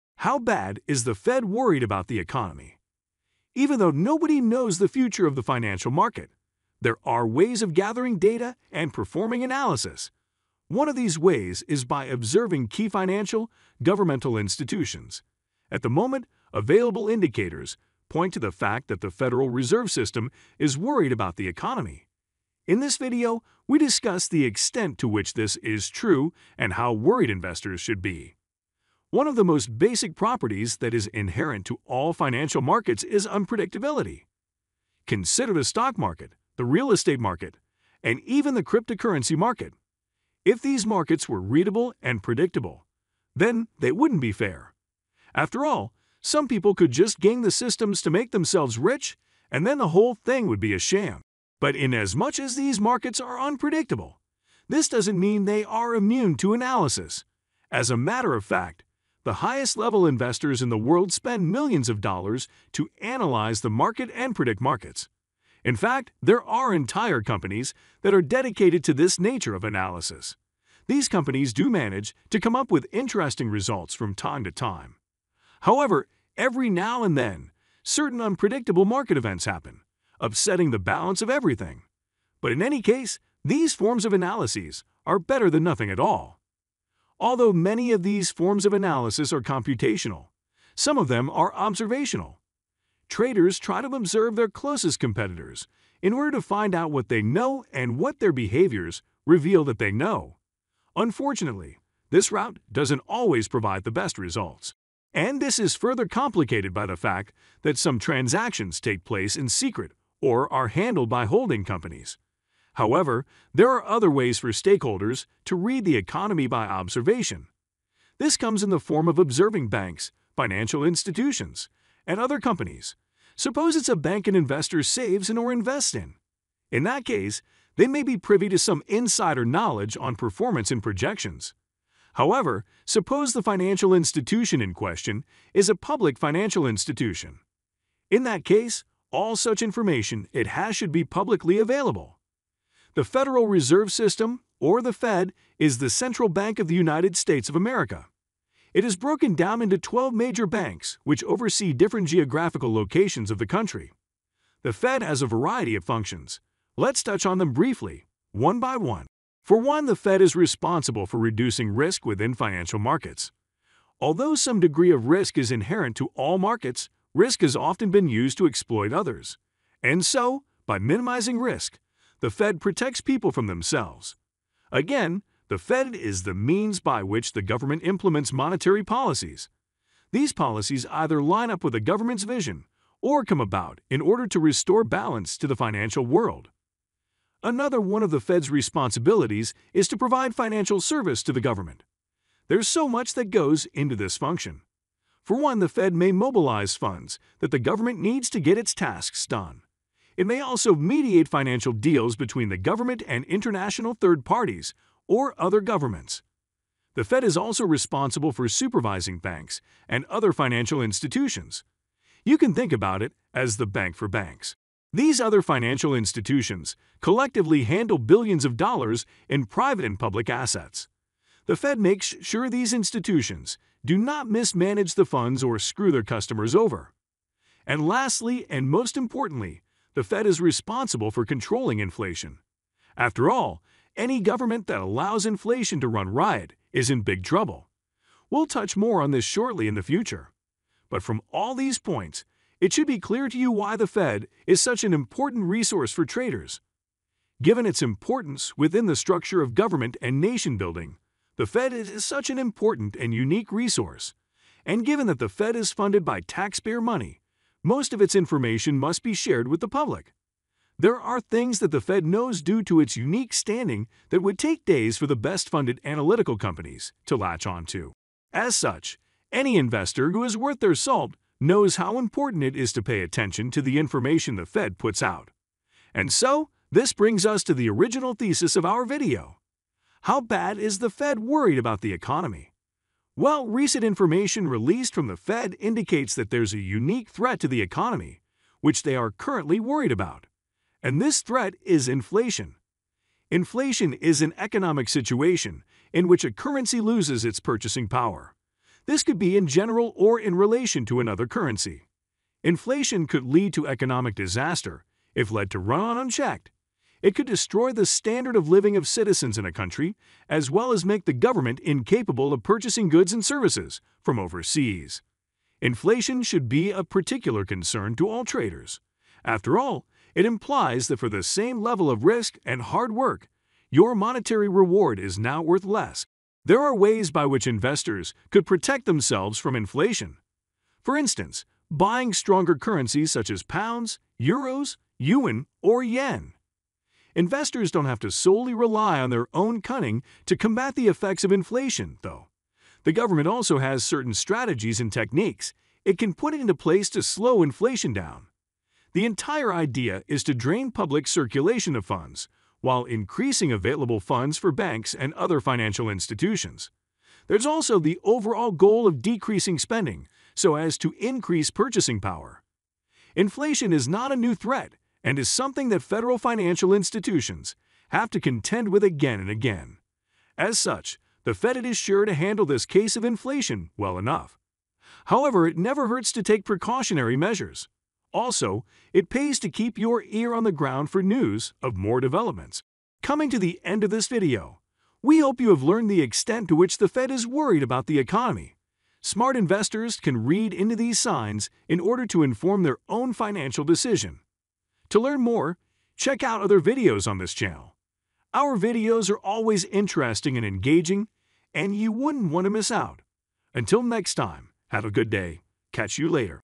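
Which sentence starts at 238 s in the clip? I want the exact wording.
We'll touch more on this shortly in the future.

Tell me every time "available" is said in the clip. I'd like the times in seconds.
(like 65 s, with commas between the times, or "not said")
16 s, 141 s, 353 s.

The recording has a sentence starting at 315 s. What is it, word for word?
Inflation should be a particular concern to all traders.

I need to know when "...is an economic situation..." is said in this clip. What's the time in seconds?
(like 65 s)
293 s.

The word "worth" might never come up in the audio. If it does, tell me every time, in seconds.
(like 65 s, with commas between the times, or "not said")
270 s, 325 s.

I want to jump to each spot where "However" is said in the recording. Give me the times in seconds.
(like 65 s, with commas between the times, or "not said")
75 s, 112 s, 132 s, 375 s.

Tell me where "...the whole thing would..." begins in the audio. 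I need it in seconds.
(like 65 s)
49 s.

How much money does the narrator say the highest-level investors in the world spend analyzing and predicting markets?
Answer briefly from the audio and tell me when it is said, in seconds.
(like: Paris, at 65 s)
Millions of dollars, at 61 s.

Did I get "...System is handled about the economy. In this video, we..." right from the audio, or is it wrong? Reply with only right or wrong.
wrong.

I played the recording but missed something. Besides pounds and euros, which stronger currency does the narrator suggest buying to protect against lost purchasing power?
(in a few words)
Yen.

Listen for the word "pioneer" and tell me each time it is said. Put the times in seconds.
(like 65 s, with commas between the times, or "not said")
not said.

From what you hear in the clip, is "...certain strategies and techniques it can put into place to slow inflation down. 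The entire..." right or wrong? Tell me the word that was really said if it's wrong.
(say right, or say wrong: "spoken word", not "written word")
right.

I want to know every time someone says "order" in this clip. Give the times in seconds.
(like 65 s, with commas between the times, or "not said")
96 s, 184 s, 391 s.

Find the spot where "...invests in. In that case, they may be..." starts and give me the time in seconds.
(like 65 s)
125 s.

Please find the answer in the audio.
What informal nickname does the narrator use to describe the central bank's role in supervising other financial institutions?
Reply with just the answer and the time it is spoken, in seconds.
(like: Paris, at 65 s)
The bank for banks, at 213 s.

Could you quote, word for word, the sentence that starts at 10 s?
One of these ways is by observing key financial, governmental institutions.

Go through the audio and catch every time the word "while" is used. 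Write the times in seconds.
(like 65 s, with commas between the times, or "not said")
283 s, 352 s.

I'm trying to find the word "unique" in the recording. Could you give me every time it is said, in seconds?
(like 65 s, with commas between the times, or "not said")
253 s, 262 s, 286 s.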